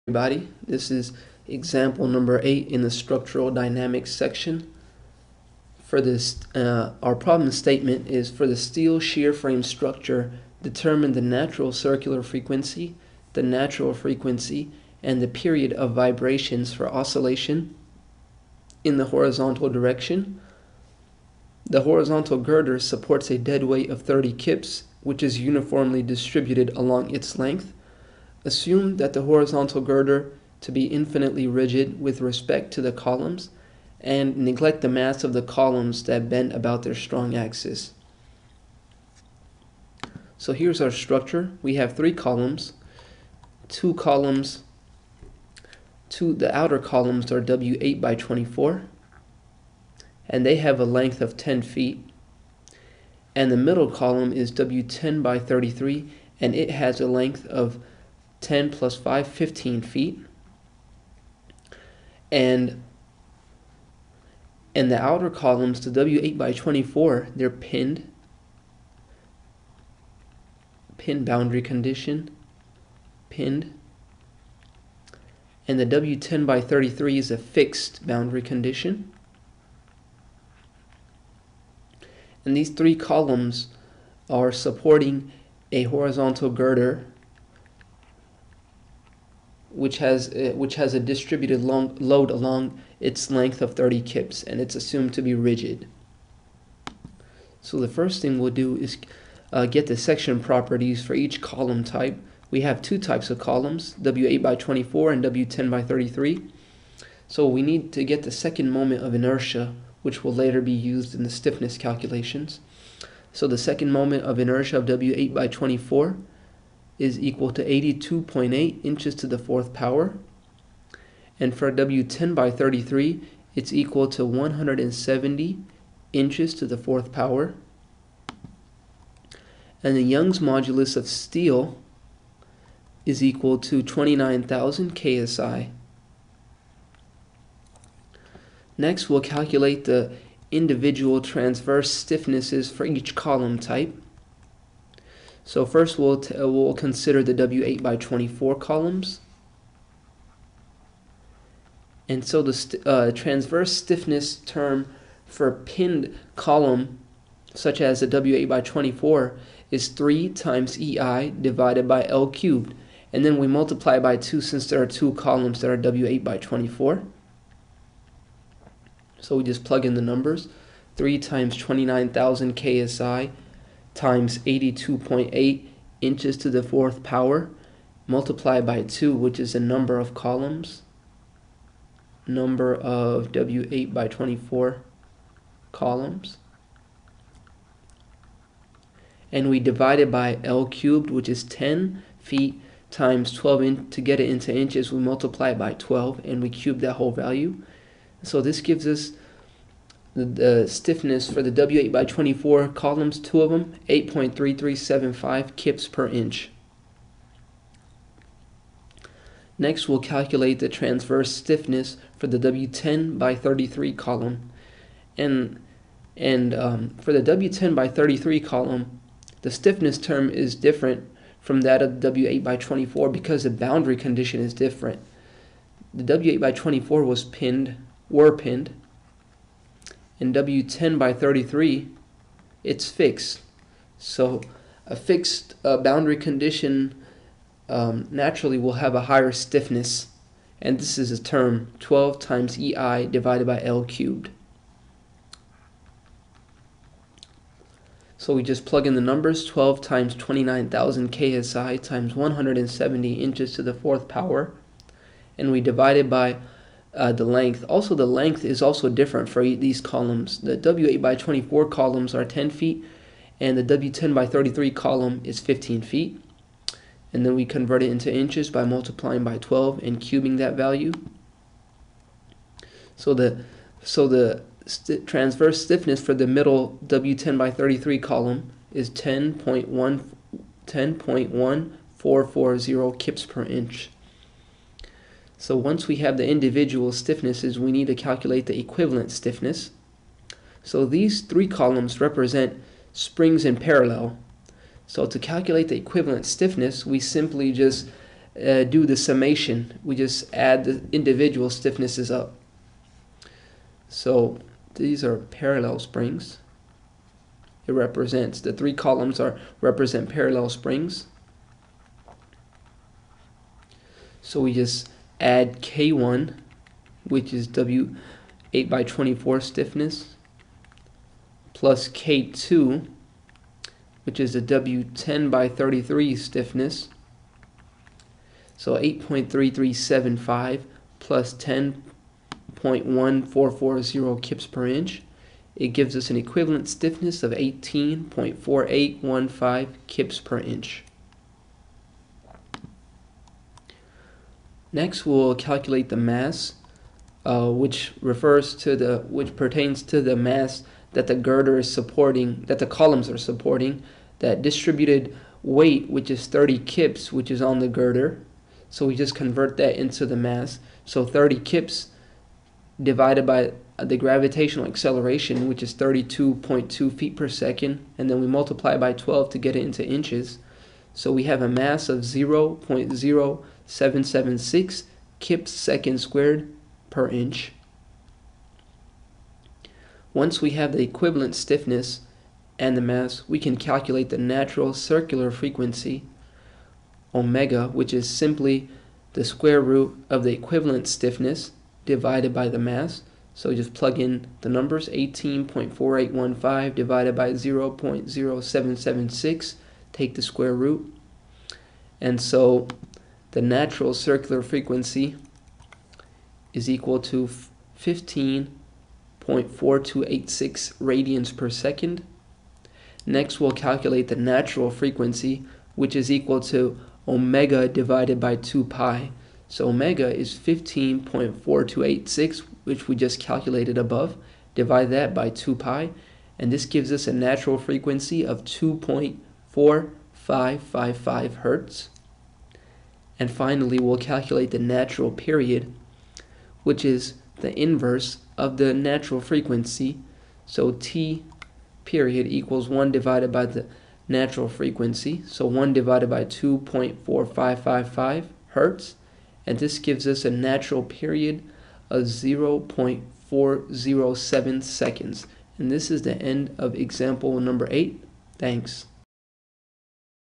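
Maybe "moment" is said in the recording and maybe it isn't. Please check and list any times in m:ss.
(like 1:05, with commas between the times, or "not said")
1:48, 1:53.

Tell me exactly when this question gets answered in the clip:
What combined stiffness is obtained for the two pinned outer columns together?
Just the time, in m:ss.
3:23.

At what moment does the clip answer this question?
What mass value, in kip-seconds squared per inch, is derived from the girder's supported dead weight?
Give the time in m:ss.
6:11.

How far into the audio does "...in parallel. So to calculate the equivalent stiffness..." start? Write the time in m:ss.
4:53.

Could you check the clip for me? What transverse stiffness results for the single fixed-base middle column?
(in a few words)
10.1440 kips per inch.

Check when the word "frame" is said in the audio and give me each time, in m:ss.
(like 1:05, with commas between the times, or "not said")
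0:09.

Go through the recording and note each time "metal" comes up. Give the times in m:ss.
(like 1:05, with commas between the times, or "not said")
not said.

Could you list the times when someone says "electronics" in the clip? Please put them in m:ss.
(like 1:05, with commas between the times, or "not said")
not said.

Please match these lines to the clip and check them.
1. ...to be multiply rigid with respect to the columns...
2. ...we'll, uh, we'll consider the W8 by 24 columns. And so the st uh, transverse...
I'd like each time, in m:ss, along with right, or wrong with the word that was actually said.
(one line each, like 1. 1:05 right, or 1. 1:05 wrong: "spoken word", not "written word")
1. 0:30 wrong: "infinitely", not "multiply"
2. 2:25 right.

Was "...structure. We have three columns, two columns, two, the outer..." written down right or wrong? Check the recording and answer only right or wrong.
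right.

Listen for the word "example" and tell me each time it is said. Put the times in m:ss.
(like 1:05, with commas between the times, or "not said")
0:01, 7:36.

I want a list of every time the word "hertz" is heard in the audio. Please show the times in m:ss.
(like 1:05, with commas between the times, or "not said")
7:11, 7:28.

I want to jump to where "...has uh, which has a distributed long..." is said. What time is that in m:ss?
1:29.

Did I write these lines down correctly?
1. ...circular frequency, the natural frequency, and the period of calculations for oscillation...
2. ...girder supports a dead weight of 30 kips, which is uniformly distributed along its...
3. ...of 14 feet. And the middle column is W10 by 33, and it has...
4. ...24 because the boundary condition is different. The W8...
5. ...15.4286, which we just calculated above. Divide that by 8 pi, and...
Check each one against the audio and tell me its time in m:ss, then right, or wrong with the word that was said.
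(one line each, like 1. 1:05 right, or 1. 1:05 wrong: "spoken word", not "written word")
1. 0:11 wrong: "vibrations", not "calculations"
2. 0:22 right
3. 0:51 wrong: "10", not "14"
4. 3:42 right
5. 7:00 wrong: "2", not "8".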